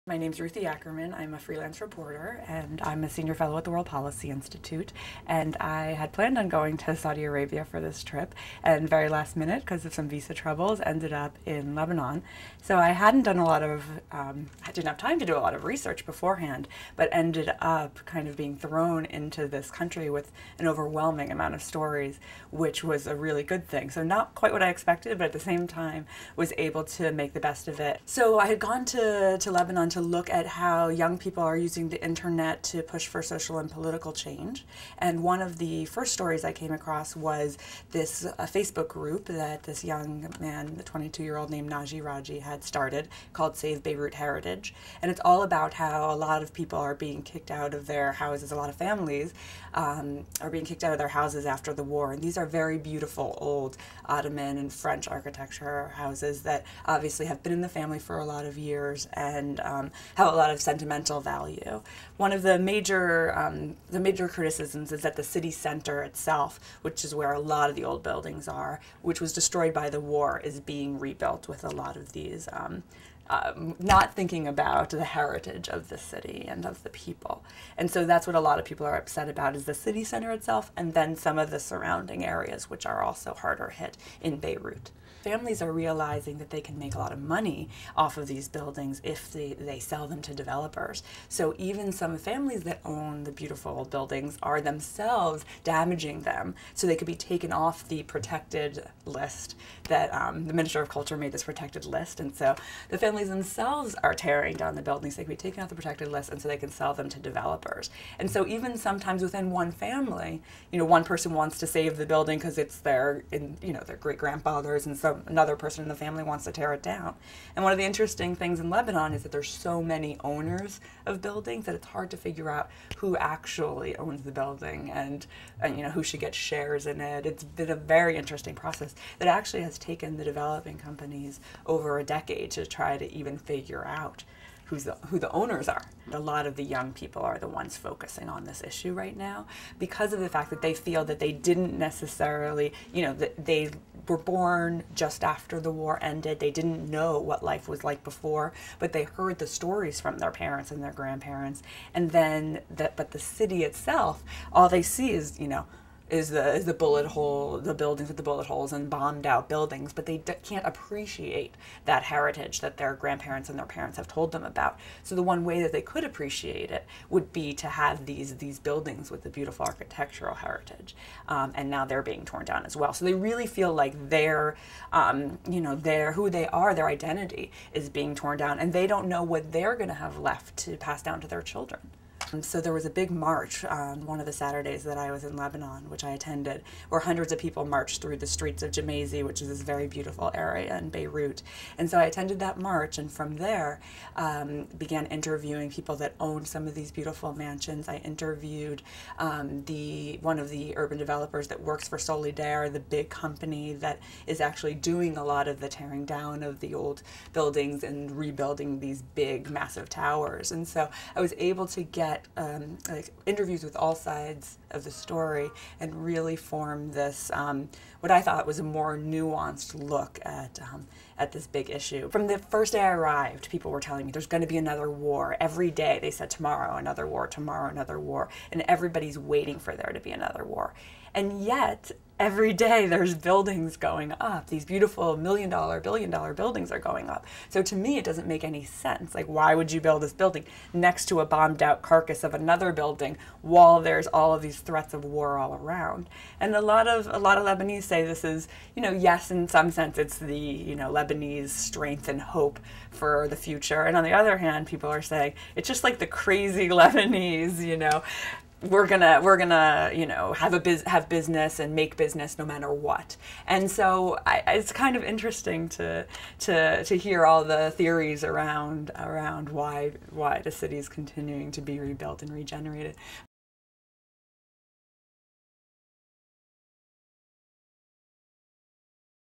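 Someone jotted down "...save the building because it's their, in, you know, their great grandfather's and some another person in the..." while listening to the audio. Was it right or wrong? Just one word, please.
right.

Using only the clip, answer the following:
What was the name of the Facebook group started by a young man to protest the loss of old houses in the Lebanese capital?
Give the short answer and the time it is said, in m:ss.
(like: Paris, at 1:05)
Save Beirut Heritage, at 0:43.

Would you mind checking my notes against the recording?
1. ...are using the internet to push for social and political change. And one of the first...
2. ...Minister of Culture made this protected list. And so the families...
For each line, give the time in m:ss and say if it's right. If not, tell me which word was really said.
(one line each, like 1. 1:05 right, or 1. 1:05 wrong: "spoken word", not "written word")
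1. 0:31 right
2. 1:40 right.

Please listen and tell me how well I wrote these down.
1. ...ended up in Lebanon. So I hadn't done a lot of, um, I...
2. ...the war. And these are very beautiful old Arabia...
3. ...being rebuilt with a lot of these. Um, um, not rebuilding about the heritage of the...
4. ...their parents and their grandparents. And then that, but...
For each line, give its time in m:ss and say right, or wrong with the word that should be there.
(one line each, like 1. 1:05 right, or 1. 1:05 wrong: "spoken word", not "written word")
1. 0:10 right
2. 0:51 wrong: "Ottoman", not "Arabia"
3. 1:10 wrong: "thinking", not "rebuilding"
4. 2:30 right.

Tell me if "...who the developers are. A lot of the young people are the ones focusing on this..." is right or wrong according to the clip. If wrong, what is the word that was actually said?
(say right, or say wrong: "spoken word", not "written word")
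wrong: "owners", not "developers".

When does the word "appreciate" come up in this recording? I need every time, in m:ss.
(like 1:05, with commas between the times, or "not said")
2:40, 2:46.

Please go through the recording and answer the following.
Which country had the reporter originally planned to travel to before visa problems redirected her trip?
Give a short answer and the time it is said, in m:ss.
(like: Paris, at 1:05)
Saudi Arabia, at 0:06.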